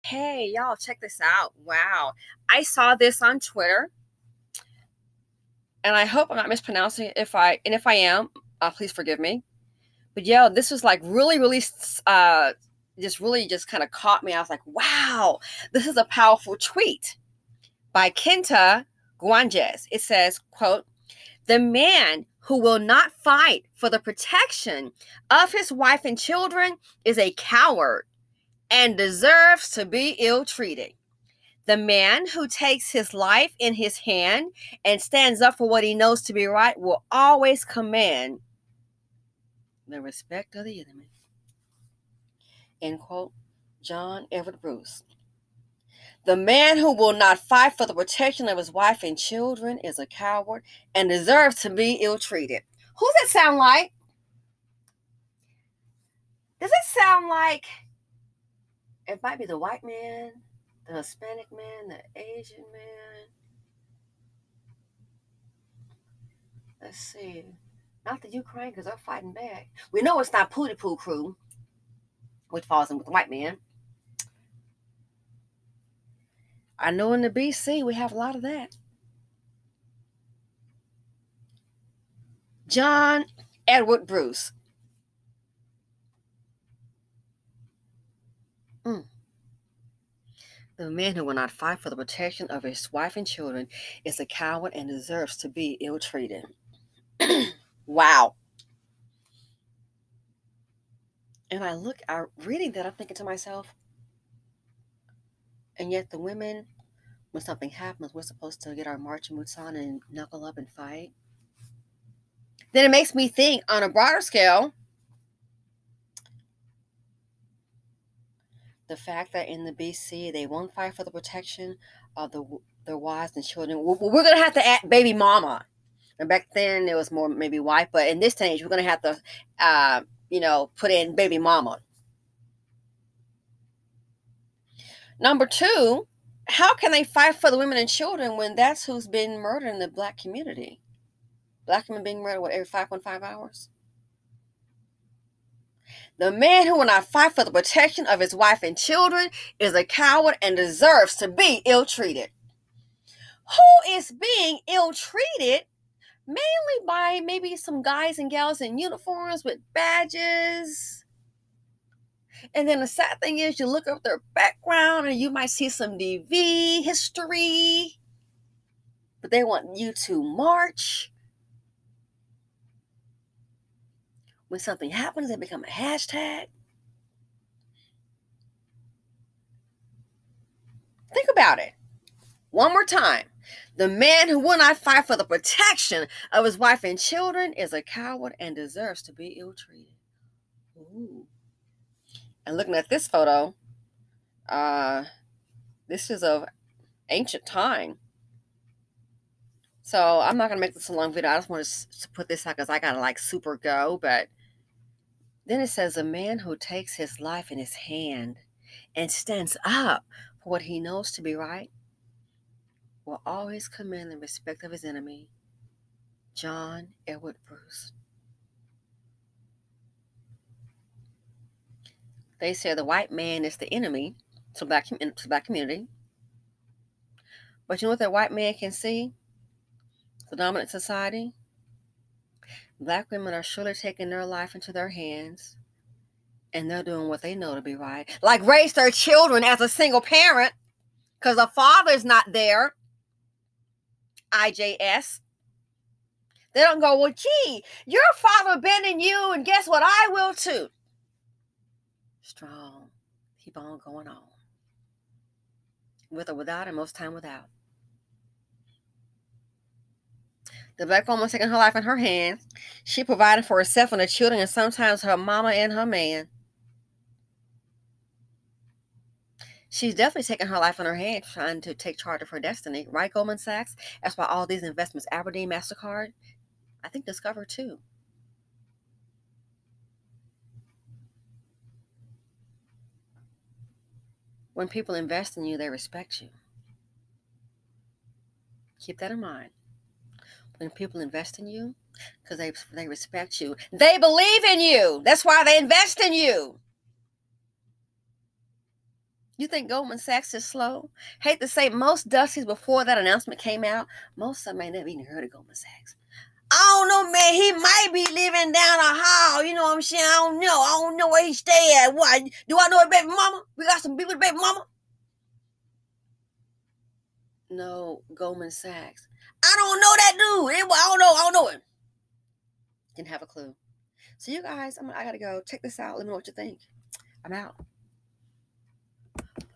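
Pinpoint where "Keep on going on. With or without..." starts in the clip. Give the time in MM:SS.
04:13.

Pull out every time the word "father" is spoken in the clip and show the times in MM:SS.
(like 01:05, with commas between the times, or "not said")
04:01, 04:08.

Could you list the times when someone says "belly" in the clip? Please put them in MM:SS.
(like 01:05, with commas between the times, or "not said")
not said.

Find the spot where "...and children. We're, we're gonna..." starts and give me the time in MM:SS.
02:03.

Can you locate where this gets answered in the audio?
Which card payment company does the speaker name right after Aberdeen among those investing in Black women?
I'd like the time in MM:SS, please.
04:35.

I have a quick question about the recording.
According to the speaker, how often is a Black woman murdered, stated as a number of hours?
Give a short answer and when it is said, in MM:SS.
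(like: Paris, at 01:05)
5.5 hours, at 02:22.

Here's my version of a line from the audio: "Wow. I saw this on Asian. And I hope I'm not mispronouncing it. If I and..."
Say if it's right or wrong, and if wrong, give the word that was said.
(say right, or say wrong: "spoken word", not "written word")
wrong: "Twitter", not "Asian".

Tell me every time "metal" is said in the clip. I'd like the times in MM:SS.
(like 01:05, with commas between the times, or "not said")
not said.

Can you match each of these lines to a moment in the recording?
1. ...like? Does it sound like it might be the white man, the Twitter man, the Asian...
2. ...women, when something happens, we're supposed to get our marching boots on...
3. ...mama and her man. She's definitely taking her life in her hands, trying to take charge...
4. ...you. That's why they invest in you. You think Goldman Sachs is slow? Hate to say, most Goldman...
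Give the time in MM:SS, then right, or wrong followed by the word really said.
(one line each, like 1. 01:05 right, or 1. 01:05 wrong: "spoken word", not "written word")
1. 00:53 wrong: "Hispanic", not "Twitter"
2. 01:46 right
3. 04:25 right
4. 04:54 wrong: "Dusties", not "Goldman".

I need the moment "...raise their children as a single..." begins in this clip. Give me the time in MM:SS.
03:58.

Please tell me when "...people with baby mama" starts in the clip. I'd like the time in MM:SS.
05:13.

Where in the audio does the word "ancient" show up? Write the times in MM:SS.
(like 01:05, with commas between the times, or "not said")
03:17.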